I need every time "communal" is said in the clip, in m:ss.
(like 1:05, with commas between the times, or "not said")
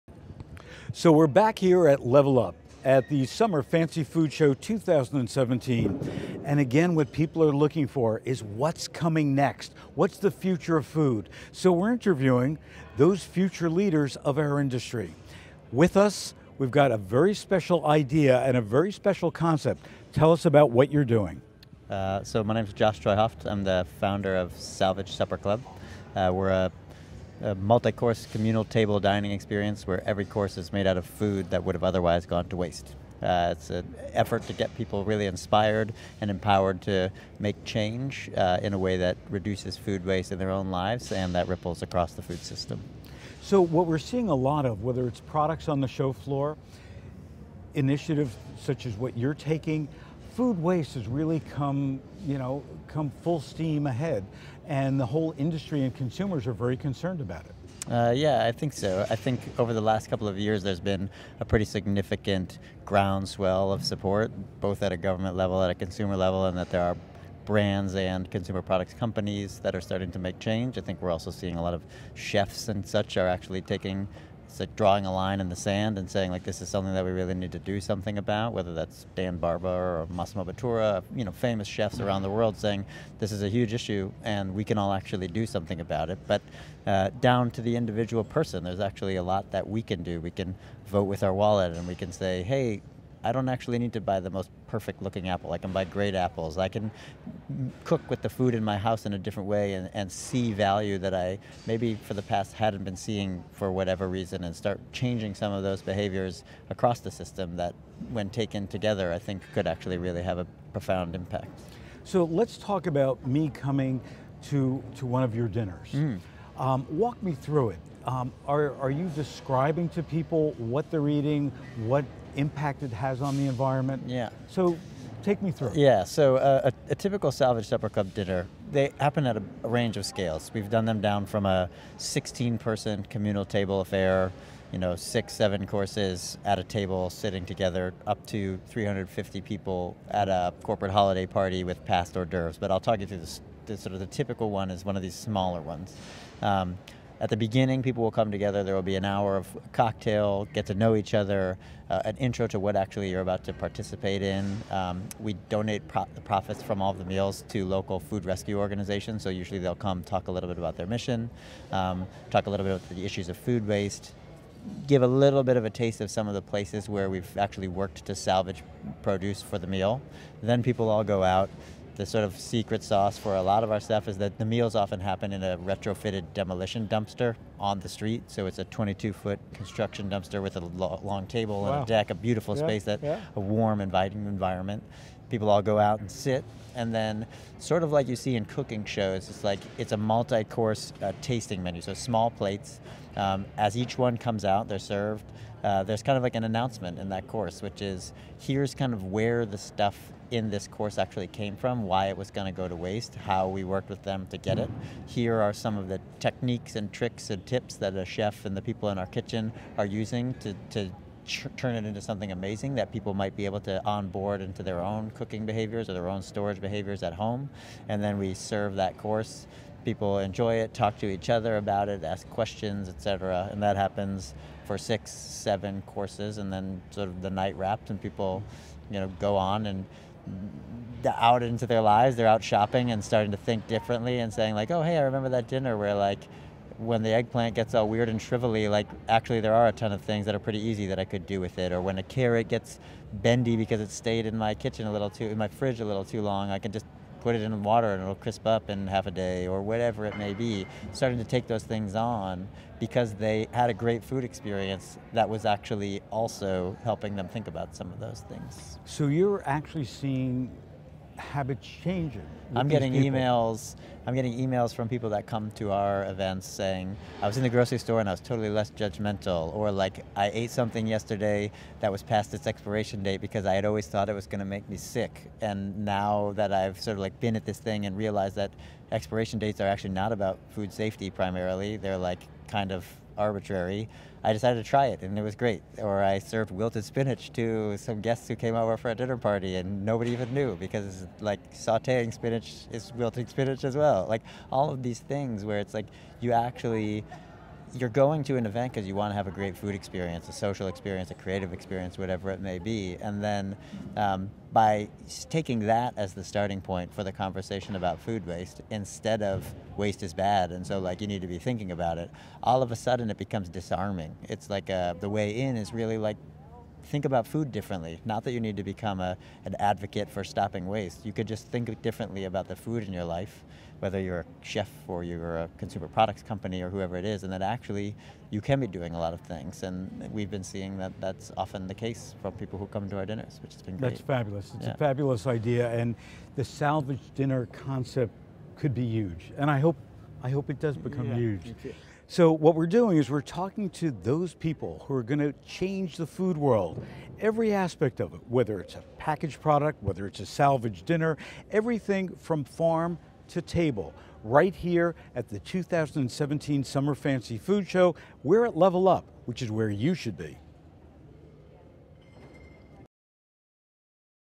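0:28, 2:13.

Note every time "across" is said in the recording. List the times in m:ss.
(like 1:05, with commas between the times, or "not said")
0:41, 1:46.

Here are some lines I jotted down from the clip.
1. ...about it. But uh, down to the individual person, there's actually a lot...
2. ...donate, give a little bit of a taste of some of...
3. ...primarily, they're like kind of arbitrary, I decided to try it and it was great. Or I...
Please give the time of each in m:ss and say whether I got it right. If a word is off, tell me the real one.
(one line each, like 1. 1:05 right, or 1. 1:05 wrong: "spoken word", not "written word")
1. 1:25 right
2. 2:43 wrong: "waste", not "donate"
3. 4:41 right.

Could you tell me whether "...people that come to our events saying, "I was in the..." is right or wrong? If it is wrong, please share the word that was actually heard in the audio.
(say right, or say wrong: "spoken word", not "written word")
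right.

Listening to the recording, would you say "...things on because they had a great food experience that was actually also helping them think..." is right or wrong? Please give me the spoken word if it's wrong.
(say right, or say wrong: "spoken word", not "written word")
right.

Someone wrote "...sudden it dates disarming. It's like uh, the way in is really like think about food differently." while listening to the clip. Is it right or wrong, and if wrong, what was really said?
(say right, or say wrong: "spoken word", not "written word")
wrong: "becomes", not "dates".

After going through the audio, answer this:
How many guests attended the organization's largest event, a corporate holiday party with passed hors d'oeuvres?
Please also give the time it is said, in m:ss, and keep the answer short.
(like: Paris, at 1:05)
350, at 2:18.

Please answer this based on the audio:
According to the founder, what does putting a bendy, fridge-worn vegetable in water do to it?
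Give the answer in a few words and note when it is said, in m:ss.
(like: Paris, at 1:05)
crisp up, at 4:08.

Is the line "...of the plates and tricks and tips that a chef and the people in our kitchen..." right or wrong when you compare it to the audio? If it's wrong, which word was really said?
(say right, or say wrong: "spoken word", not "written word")
wrong: "techniques", not "plates".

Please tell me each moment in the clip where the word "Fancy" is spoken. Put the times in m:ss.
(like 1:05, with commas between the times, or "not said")
0:03, 5:56.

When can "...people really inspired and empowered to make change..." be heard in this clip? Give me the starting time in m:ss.
0:34.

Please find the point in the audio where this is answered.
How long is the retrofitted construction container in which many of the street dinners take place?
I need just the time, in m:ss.
2:58.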